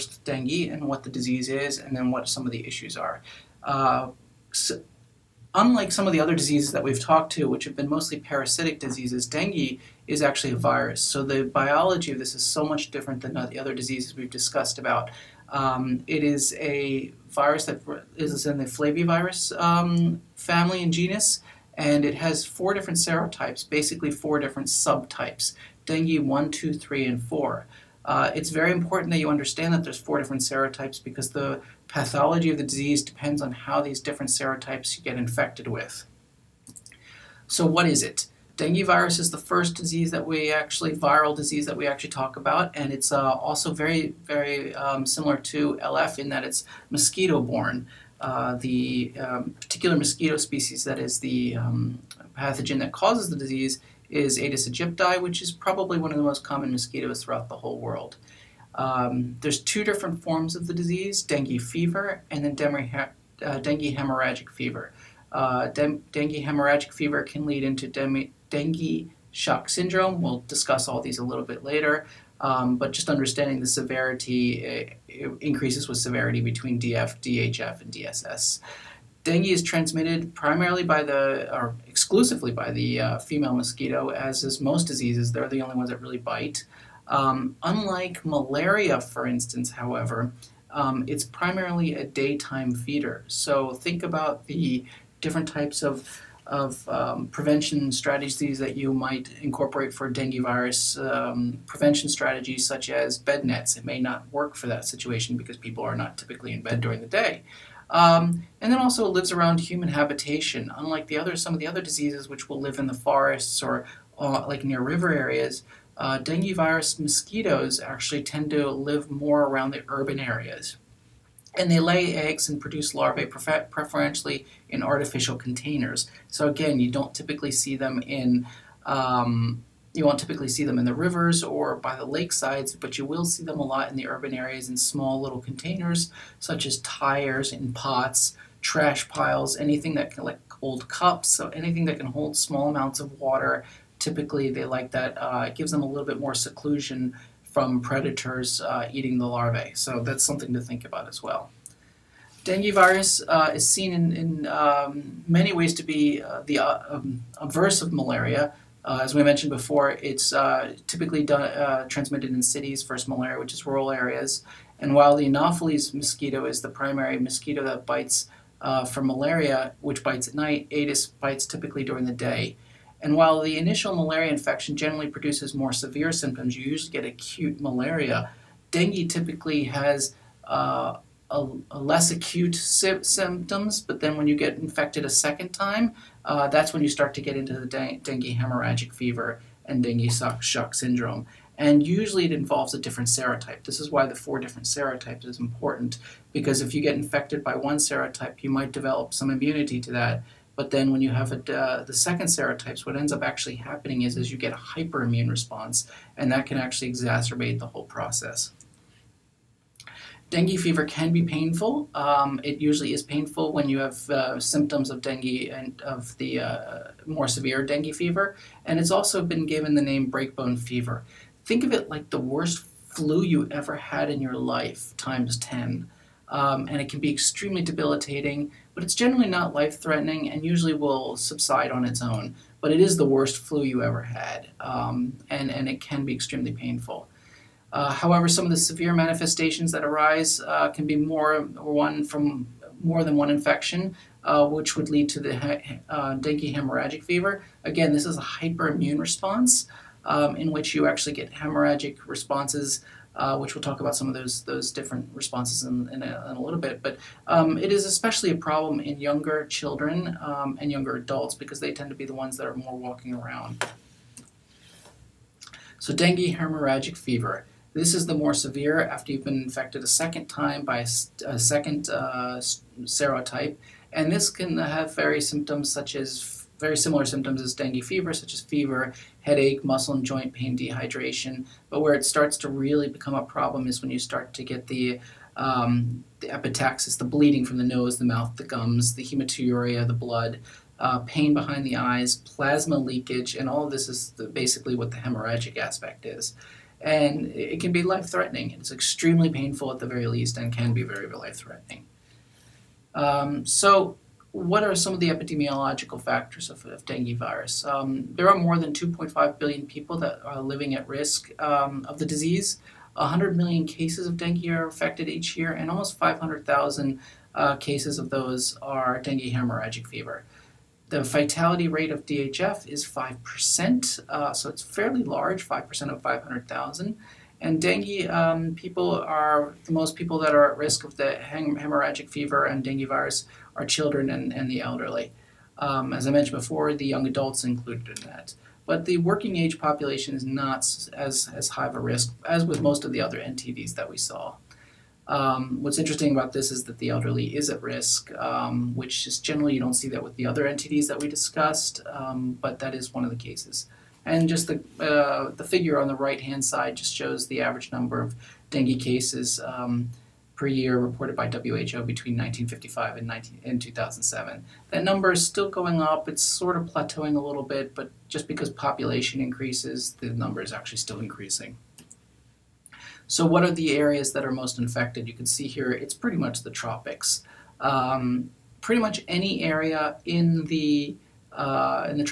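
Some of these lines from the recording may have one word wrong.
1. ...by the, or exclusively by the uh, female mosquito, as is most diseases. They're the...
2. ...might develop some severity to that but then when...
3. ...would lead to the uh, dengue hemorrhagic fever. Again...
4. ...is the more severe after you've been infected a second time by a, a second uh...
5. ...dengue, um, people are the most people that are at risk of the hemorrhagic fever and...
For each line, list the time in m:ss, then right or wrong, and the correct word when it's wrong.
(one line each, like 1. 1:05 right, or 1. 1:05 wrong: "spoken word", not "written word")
1. 1:20 right
2. 3:18 wrong: "immunity", not "severity"
3. 4:04 right
4. 4:27 right
5. 5:27 right.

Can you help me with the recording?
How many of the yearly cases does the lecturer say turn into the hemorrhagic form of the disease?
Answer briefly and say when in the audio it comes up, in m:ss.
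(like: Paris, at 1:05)
almost 500,000, at 5:15.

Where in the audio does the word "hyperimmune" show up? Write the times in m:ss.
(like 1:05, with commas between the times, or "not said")
3:24, 4:08.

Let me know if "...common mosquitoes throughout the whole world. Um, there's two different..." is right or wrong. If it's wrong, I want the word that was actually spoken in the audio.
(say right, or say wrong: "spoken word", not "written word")
right.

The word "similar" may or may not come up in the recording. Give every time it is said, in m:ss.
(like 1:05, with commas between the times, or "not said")
0:45, 4:36.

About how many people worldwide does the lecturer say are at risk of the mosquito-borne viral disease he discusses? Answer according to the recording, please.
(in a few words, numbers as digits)
more than 2.5 billion.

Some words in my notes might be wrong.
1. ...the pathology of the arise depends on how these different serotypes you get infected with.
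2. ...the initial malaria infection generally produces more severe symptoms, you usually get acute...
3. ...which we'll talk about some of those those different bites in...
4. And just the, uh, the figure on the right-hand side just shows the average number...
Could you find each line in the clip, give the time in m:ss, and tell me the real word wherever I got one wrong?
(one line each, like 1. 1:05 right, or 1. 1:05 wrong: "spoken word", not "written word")
1. 0:31 wrong: "disease", not "arise"
2. 2:53 right
3. 4:13 wrong: "responses", not "bites"
4. 5:54 right.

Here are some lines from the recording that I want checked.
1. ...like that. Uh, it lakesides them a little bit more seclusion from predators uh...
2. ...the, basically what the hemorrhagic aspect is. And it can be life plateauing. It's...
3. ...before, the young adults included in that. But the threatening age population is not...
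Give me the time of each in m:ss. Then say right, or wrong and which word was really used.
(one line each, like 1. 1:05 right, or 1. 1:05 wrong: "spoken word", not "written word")
1. 2:24 wrong: "gives", not "lakesides"
2. 4:54 wrong: "threatening", not "plateauing"
3. 5:36 wrong: "working", not "threatening".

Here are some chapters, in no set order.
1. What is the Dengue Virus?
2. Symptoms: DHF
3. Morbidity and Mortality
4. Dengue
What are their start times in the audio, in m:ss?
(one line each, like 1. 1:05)
1. 0:36
2. 4:23
3. 5:00
4. 2:30.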